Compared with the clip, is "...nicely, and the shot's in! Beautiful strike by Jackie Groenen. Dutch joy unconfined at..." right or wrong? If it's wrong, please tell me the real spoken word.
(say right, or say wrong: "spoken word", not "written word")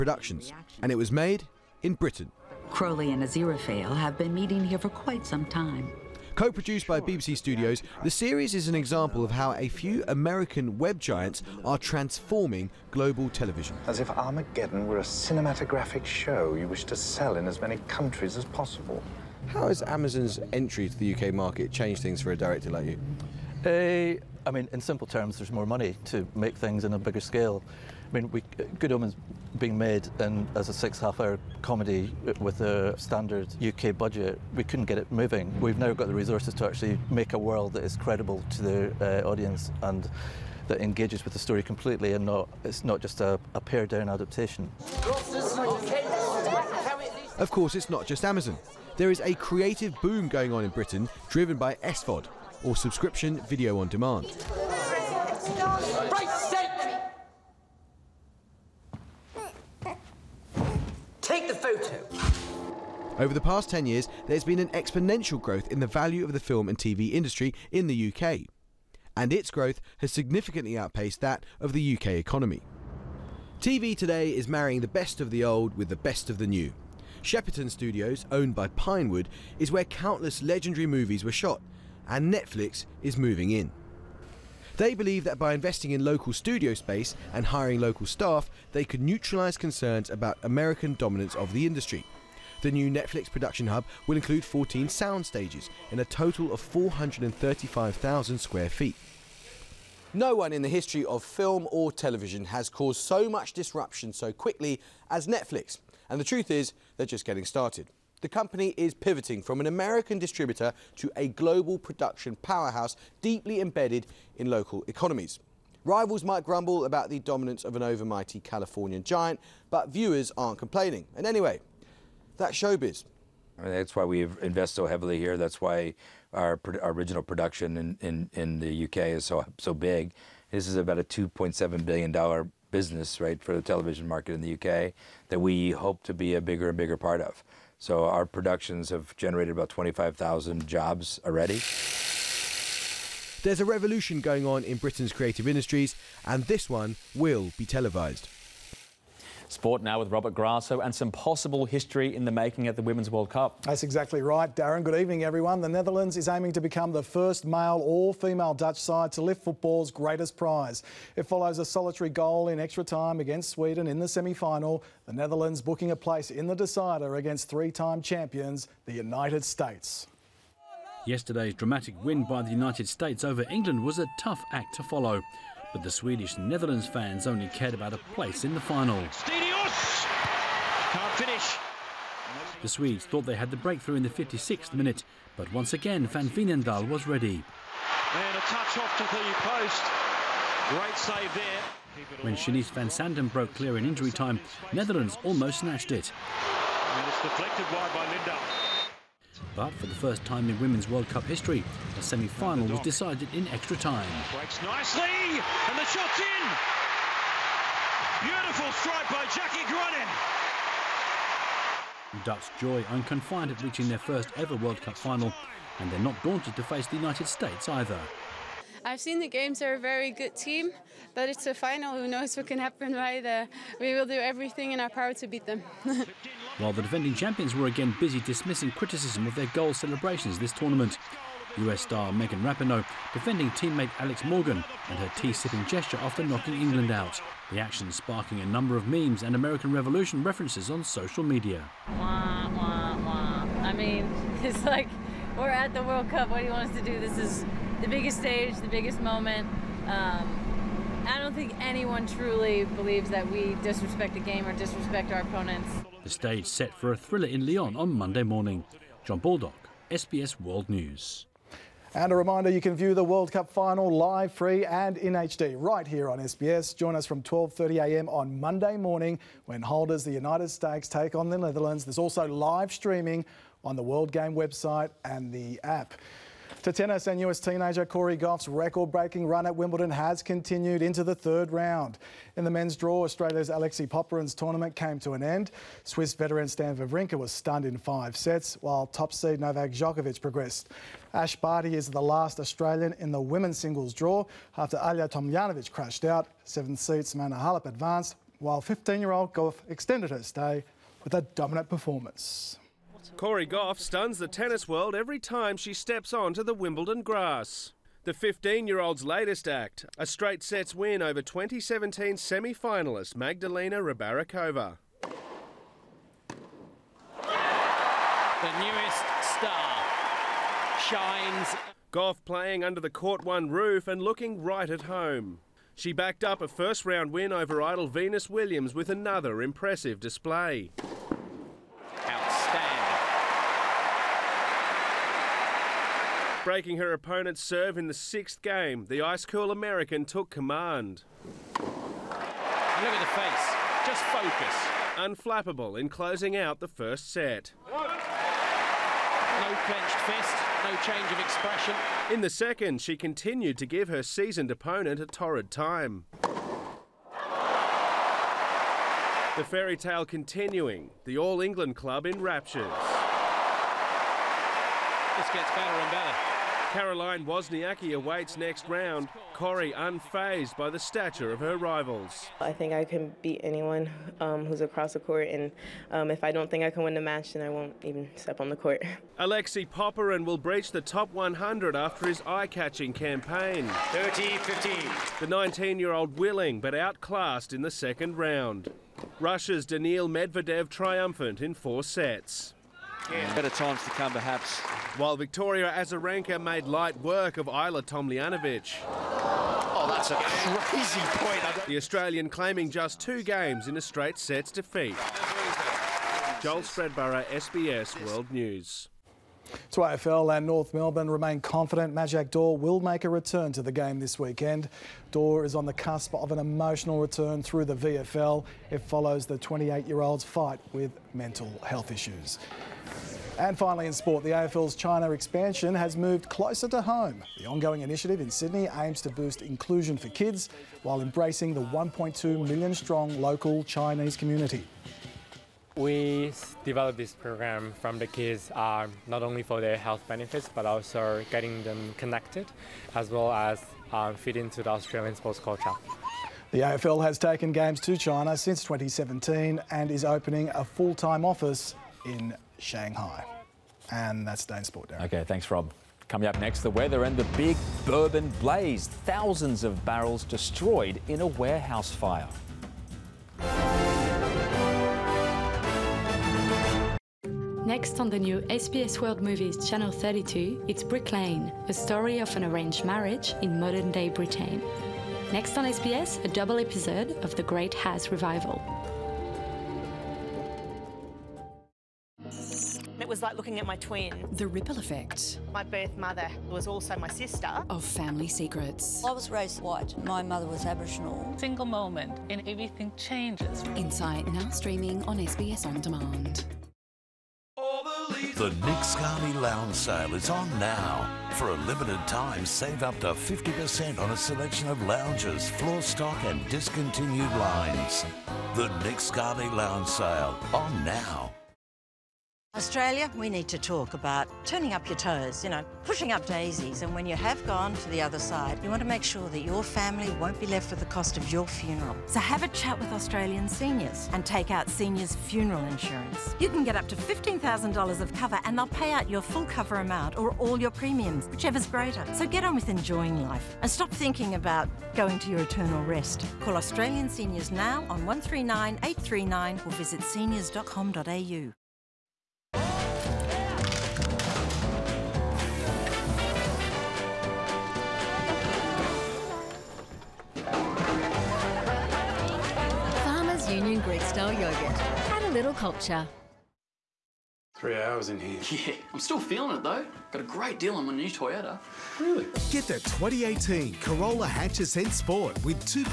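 right.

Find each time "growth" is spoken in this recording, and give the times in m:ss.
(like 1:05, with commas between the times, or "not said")
1:05, 1:09.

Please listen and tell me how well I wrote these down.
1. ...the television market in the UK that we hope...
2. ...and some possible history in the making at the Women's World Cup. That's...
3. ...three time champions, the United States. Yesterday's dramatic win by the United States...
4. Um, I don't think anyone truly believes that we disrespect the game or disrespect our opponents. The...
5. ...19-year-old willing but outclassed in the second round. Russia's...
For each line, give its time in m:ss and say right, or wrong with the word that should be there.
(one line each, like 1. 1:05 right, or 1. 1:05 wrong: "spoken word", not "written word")
1. 2:13 right
2. 2:30 right
3. 2:47 right
4. 4:09 right
5. 6:25 right.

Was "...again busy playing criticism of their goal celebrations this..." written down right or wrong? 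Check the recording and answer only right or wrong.
wrong.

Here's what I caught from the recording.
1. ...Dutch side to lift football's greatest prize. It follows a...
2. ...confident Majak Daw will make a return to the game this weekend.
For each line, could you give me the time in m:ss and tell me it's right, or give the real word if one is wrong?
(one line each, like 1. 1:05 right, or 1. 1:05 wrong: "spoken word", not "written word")
1. 2:38 right
2. 6:51 right.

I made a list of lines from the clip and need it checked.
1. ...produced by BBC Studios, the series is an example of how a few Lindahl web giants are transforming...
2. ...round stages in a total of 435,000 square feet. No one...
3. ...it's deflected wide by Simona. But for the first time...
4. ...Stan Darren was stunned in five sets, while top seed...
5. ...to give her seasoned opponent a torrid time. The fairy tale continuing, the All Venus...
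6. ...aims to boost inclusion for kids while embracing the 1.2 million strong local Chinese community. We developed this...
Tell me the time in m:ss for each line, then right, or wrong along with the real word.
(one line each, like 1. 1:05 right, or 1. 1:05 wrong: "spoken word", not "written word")
1. 0:06 wrong: "American", not "Lindahl"
2. 1:34 wrong: "sound", not "round"
3. 3:17 wrong: "Lindahl", not "Simona"
4. 4:46 wrong: "Wawrinka", not "Darren"
5. 5:53 wrong: "England", not "Venus"
6. 7:08 right.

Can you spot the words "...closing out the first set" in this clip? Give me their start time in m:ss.
5:45.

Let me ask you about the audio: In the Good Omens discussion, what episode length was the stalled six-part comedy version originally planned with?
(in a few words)
half hour.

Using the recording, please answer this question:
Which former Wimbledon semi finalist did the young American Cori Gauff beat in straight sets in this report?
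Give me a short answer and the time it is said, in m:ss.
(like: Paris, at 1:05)
Magdalena Rybarikova, at 5:13.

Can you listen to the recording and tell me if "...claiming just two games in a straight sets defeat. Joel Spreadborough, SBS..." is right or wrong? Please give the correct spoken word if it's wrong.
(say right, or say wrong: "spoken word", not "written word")
right.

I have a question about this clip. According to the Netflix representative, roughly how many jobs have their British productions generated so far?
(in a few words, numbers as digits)
25,000.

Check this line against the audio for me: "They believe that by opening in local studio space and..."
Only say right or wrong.
wrong.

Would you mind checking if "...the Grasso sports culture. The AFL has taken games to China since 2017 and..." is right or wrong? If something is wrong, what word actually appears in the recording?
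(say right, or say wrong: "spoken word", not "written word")
wrong: "Australian", not "Grasso".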